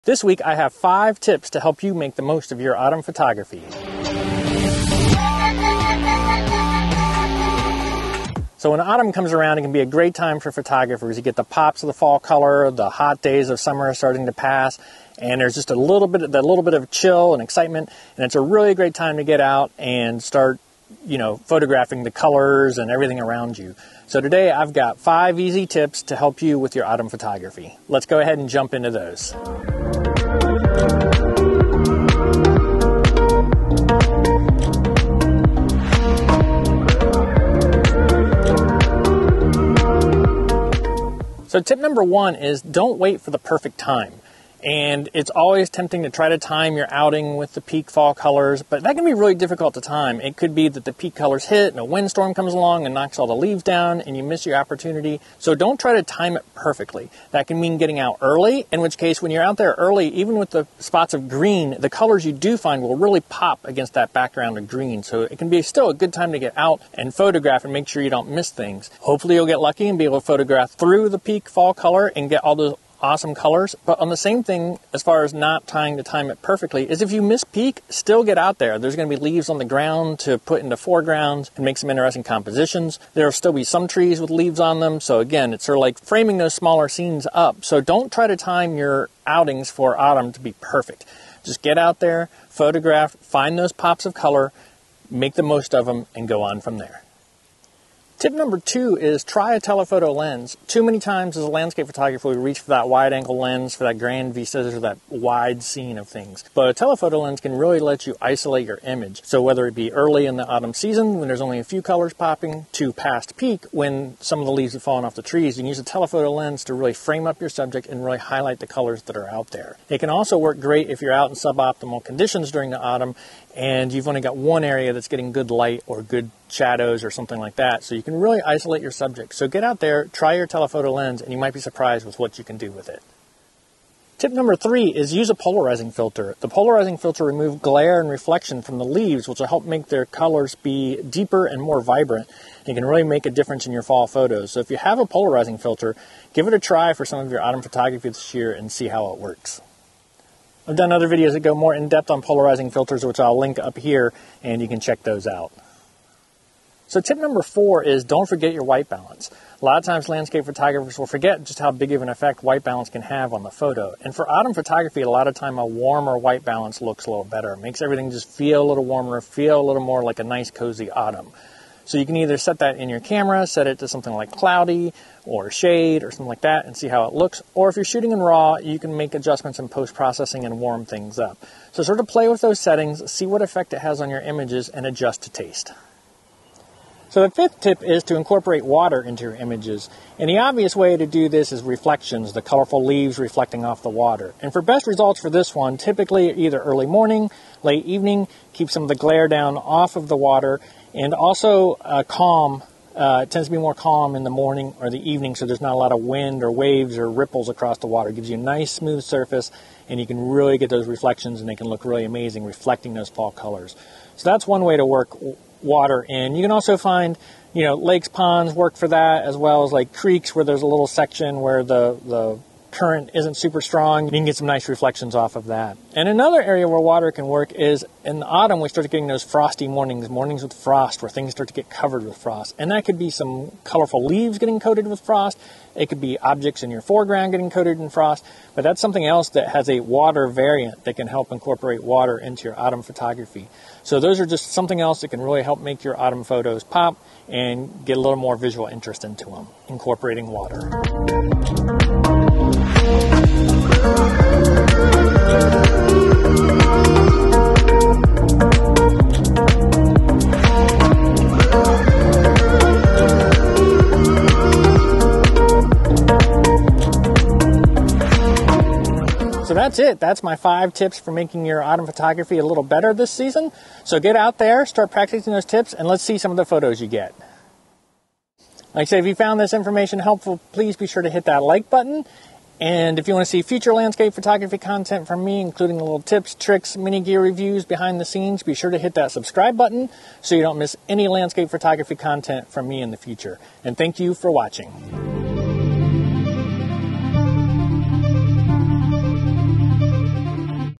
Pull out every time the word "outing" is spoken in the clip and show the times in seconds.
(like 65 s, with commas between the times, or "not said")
46 s, 89 s.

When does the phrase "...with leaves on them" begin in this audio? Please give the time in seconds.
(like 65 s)
84 s.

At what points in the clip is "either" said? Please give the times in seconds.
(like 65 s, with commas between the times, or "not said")
172 s, 196 s.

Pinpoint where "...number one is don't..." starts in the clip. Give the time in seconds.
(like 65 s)
41 s.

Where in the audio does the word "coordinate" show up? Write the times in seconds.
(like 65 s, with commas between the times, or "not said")
not said.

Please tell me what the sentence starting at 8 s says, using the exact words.
So, when autumn comes around, it can be a great time for photographers.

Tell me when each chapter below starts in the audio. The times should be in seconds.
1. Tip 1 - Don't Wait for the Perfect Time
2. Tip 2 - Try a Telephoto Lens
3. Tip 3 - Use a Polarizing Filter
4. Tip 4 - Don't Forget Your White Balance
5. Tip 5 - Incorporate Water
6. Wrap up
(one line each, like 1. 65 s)
1. 41 s
2. 98 s
3. 134 s
4. 157 s
5. 187 s
6. 269 s.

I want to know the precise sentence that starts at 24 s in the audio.
So, today I've got five easy tips to help you with your autumn photography.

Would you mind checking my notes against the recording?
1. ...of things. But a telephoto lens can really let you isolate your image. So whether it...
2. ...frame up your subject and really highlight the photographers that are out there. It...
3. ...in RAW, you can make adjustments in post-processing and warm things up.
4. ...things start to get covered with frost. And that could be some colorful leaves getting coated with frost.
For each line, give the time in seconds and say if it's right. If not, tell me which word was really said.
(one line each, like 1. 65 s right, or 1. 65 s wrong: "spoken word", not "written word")
1. 105 s right
2. 116 s wrong: "colors", not "photographers"
3. 178 s right
4. 231 s right.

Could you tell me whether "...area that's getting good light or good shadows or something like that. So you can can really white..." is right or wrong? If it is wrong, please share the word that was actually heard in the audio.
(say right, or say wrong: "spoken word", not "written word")
wrong: "isolate", not "white".